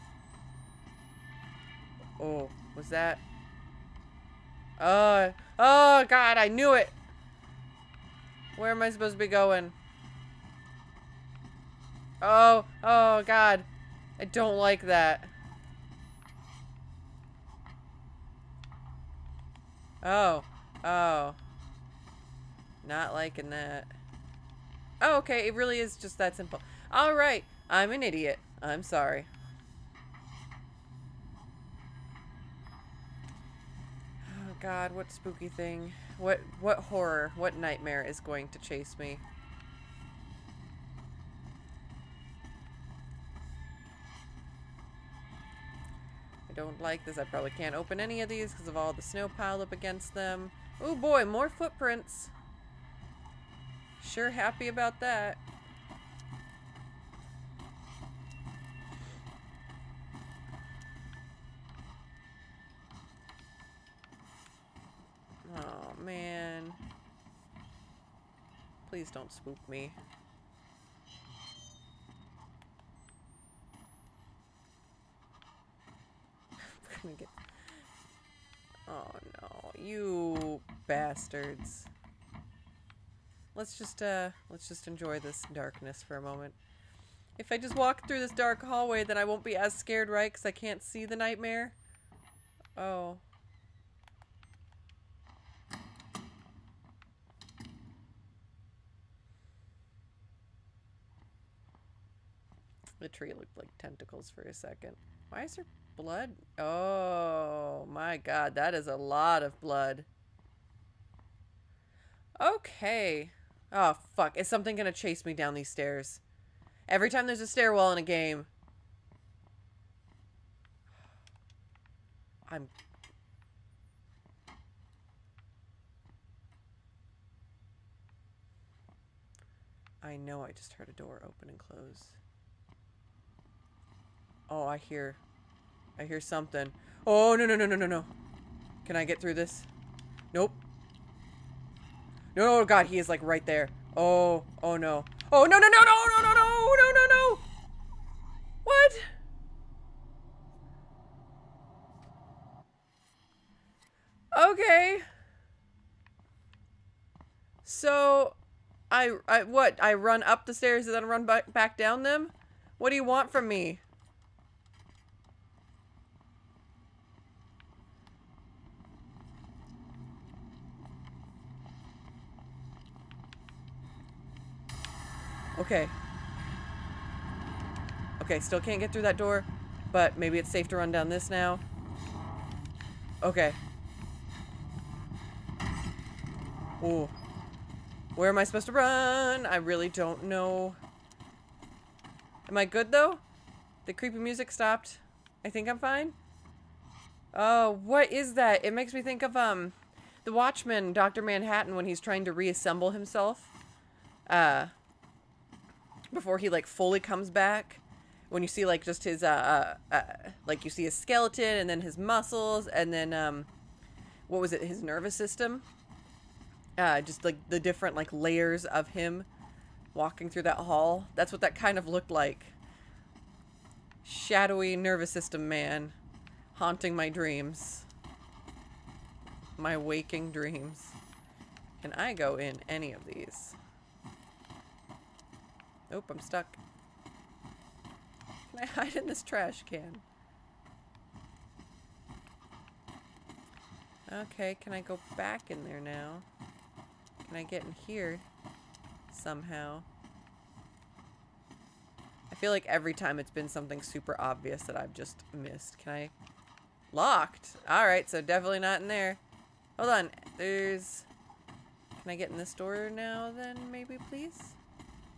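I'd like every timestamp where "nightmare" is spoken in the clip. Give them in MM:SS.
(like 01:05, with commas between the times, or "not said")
00:37, 01:31.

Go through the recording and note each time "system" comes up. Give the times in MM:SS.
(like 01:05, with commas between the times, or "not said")
03:35, 03:45.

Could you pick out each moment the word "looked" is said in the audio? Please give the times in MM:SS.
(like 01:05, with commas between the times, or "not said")
01:43, 03:41.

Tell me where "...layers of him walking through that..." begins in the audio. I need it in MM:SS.
03:38.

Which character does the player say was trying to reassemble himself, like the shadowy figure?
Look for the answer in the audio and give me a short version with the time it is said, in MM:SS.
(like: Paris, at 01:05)
Dr. Manhattan, at 03:20.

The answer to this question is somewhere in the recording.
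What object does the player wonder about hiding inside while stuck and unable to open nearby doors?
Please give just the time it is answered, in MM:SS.
03:59.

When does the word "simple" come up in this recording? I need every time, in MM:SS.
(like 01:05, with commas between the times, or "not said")
00:26.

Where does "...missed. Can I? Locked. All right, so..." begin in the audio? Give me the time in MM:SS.
04:15.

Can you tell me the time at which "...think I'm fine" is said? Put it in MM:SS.
03:15.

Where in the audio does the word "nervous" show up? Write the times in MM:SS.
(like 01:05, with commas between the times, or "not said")
03:34, 03:44.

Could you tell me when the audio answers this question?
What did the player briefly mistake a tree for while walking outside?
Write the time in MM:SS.
01:43.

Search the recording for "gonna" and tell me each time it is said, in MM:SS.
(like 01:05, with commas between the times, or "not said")
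01:17, 01:54.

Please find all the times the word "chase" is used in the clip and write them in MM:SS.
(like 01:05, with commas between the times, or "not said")
00:38, 01:54.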